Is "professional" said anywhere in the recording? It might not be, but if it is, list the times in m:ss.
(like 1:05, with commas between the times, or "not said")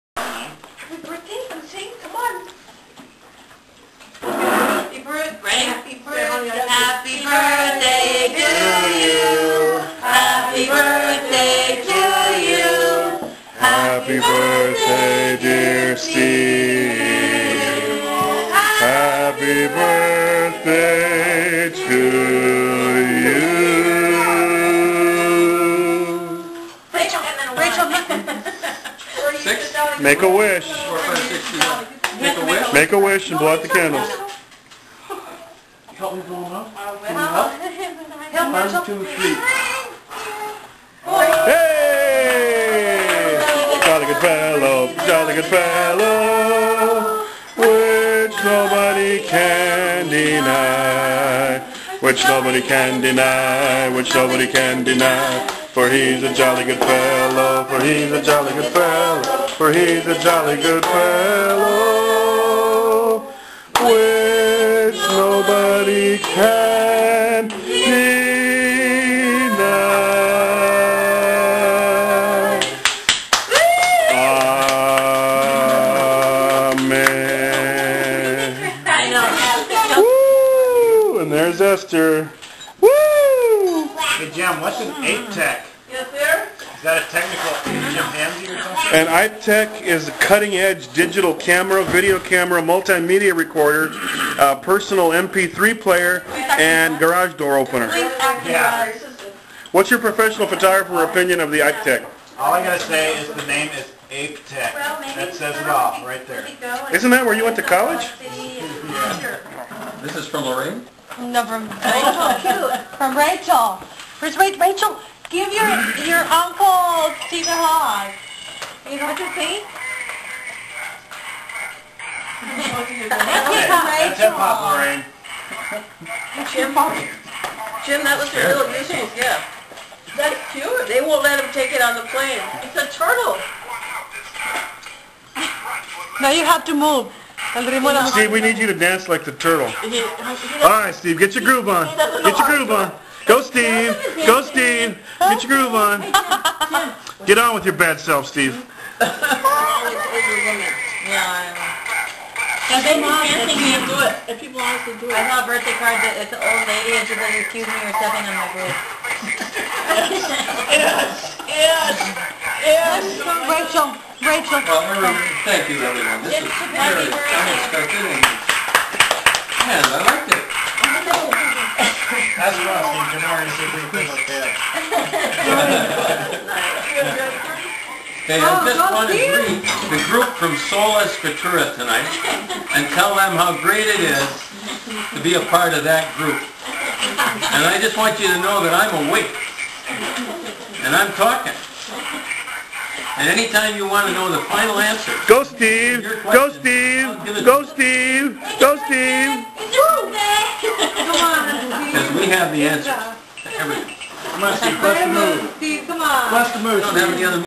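1:39.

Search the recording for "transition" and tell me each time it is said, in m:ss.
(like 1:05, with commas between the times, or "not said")
not said.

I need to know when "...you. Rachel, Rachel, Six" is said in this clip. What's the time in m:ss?
0:26.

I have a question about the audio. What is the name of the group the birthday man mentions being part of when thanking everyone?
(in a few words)
Sola Scriptura.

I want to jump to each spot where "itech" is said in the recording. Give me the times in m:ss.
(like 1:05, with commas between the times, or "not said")
1:29, 1:41.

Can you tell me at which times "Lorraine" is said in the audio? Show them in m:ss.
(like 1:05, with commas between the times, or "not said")
1:50, 2:04.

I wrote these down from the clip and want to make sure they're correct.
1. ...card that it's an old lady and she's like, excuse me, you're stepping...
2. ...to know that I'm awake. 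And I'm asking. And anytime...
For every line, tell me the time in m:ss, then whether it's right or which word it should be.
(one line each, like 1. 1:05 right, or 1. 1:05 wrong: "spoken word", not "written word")
1. 2:35 right
2. 3:08 wrong: "talking", not "asking".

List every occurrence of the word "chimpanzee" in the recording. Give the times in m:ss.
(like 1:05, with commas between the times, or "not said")
1:27.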